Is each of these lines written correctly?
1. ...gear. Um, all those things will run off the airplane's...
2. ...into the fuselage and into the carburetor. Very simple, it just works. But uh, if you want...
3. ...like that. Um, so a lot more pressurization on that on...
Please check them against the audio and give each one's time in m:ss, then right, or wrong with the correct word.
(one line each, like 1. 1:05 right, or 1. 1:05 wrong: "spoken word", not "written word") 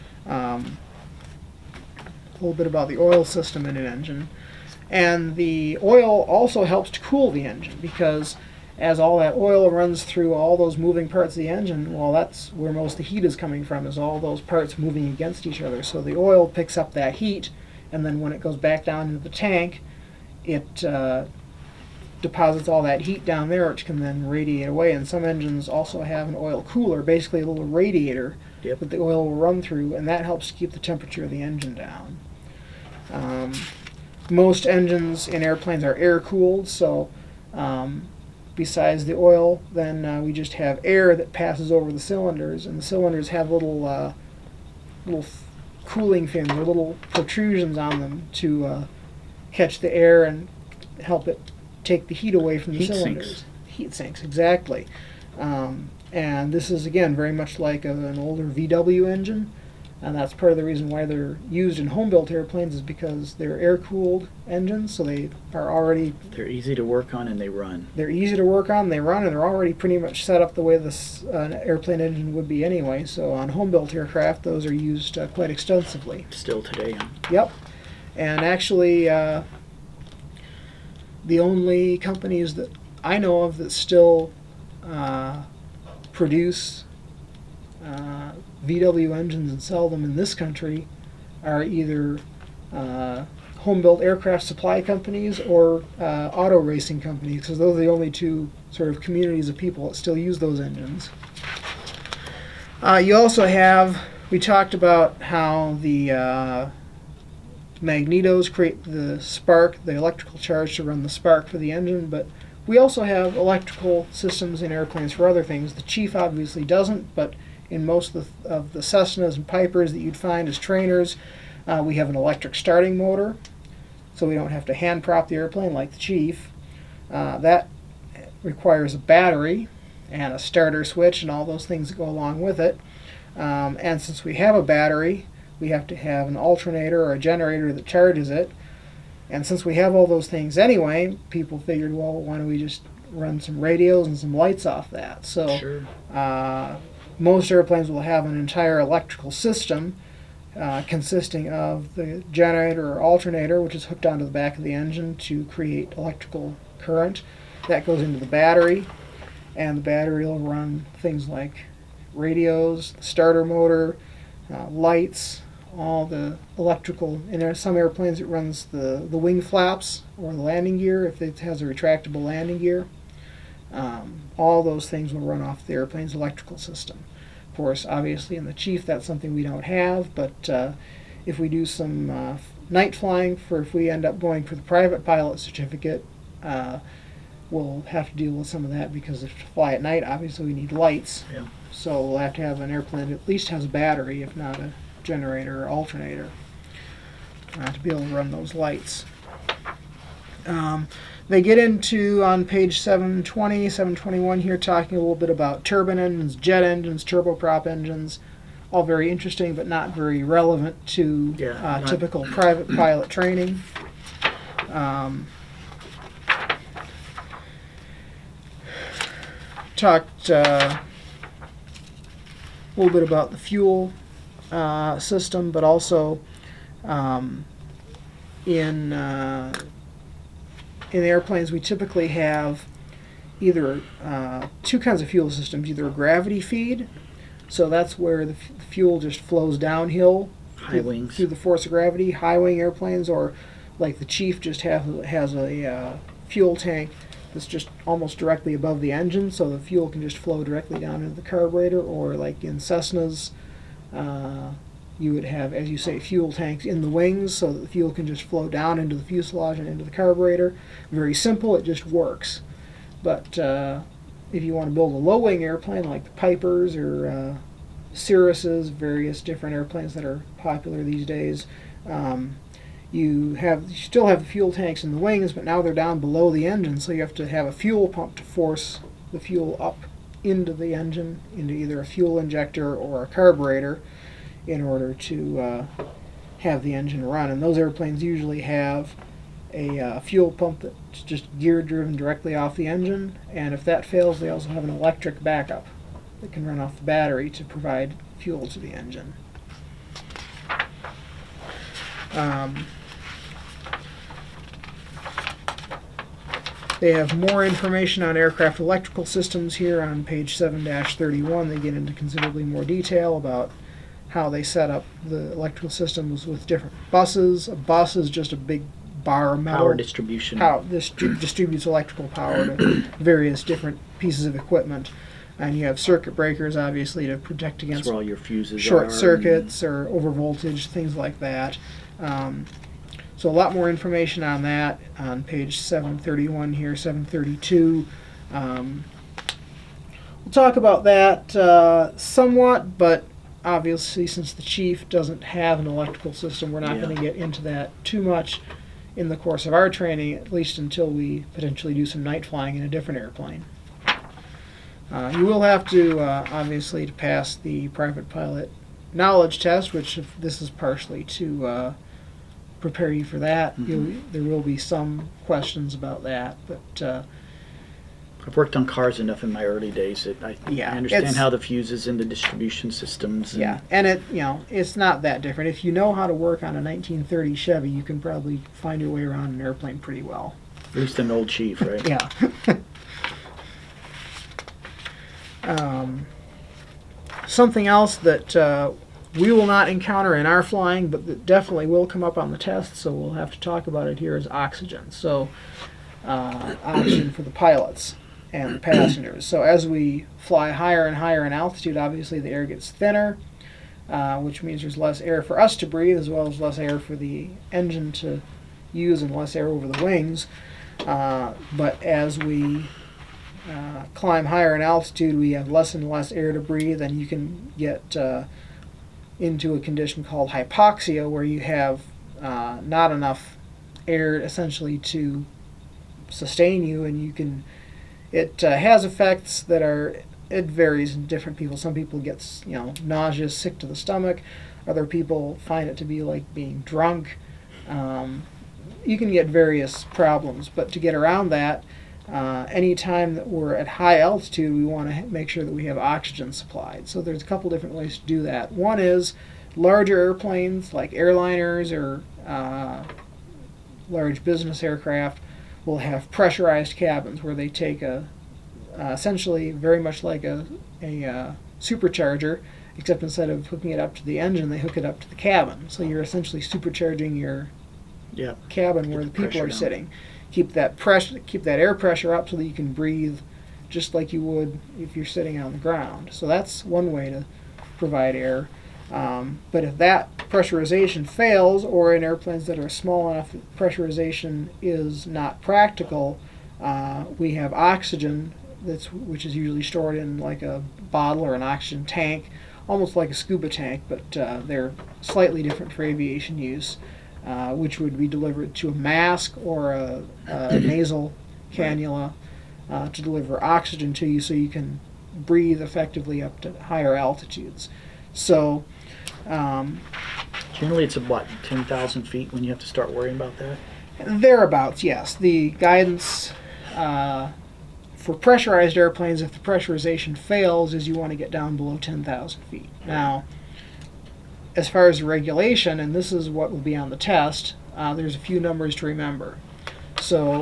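1. 2:52 right
2. 4:18 right
3. 5:30 wrong: "information", not "pressurization".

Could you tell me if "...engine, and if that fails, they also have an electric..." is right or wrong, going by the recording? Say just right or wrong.
right.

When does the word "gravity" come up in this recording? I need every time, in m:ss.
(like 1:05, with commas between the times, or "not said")
3:55, 4:01.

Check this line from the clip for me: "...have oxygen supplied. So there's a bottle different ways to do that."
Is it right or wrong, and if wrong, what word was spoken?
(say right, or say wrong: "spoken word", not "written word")
wrong: "couple", not "bottle".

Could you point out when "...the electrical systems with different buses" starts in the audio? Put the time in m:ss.
5:15.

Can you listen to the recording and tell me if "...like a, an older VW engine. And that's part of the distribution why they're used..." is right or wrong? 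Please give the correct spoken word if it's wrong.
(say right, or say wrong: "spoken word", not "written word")
wrong: "reason", not "distribution".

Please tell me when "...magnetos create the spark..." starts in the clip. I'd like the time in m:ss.
1:47.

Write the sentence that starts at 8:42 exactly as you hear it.
Now, as far as regulation, and this is what will be on the test, uh, there's a few numbers to remember.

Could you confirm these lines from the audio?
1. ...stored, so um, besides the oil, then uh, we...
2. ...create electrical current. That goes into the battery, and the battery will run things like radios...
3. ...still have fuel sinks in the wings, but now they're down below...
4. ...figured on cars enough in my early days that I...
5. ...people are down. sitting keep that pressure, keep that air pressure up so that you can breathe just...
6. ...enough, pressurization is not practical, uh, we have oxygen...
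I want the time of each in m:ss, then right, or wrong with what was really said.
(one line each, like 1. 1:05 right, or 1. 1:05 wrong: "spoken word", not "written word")
1. 0:36 wrong: "cooled", not "stored"
2. 2:35 right
3. 4:33 wrong: "tanks", not "sinks"
4. 6:08 wrong: "worked", not "figured"
5. 7:49 right
6. 8:03 right.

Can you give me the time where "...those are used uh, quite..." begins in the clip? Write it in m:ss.
1:14.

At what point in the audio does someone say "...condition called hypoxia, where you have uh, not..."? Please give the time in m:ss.
6:59.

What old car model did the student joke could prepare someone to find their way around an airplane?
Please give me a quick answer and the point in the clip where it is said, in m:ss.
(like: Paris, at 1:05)
1930 Chevy, at 6:16.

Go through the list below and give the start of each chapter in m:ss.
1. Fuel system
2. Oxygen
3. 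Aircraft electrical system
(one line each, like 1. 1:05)
1. 3:37
2. 6:25
3. 1:41.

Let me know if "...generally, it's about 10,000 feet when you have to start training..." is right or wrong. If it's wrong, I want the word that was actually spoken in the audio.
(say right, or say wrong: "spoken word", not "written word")
wrong: "worrying", not "training".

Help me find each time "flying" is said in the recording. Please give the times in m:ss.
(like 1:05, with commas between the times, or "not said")
3:02, 5:52, 6:30.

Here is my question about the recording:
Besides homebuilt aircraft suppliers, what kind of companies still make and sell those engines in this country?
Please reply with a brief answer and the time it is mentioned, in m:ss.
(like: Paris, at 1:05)
auto racing companies, at 1:36.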